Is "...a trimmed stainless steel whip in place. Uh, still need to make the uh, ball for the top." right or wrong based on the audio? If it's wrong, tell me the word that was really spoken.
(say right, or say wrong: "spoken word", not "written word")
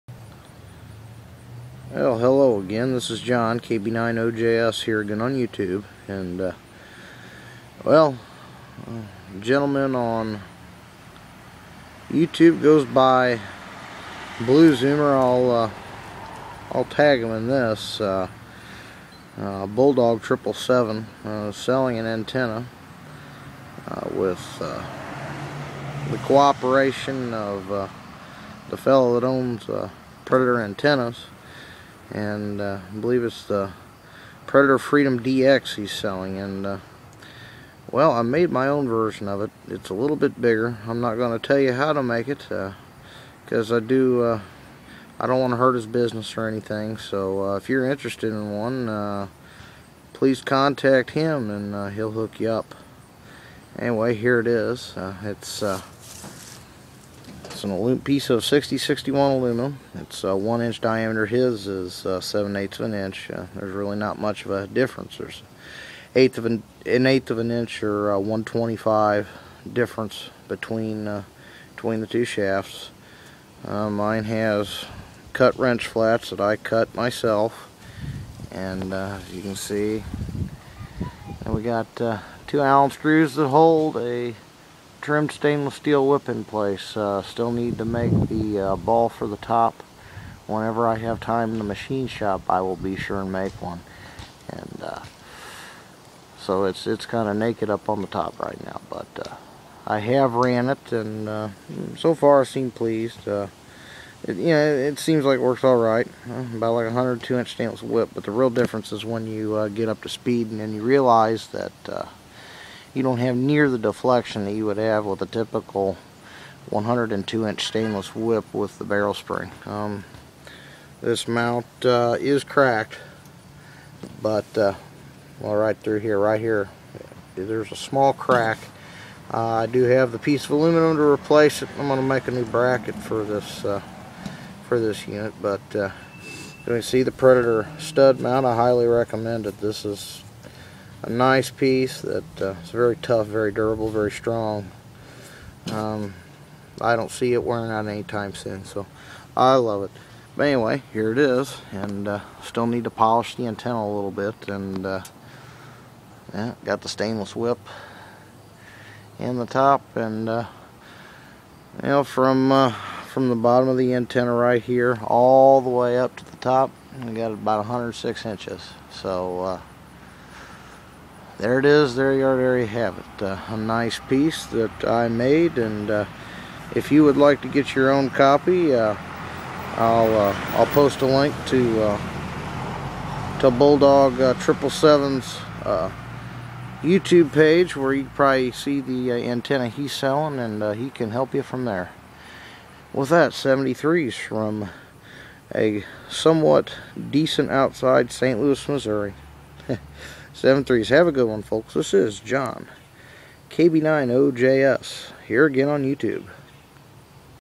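right.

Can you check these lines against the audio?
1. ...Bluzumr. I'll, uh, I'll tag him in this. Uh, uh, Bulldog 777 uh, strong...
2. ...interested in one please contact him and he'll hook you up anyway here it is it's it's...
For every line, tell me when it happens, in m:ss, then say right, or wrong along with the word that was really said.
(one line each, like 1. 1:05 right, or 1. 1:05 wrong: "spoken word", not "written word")
1. 0:14 wrong: "selling", not "strong"
2. 0:47 right.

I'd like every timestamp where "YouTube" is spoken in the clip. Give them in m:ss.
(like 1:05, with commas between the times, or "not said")
0:05, 0:12, 3:06, 3:25.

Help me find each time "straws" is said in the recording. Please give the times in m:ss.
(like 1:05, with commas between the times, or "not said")
not said.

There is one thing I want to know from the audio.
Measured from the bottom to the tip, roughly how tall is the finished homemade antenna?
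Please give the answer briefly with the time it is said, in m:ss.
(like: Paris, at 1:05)
106 inches, at 2:47.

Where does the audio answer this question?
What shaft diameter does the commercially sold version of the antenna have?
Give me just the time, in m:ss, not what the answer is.
1:02.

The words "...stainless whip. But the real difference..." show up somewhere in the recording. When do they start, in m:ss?
1:47.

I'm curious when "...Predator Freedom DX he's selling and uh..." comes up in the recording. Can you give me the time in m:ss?
0:34.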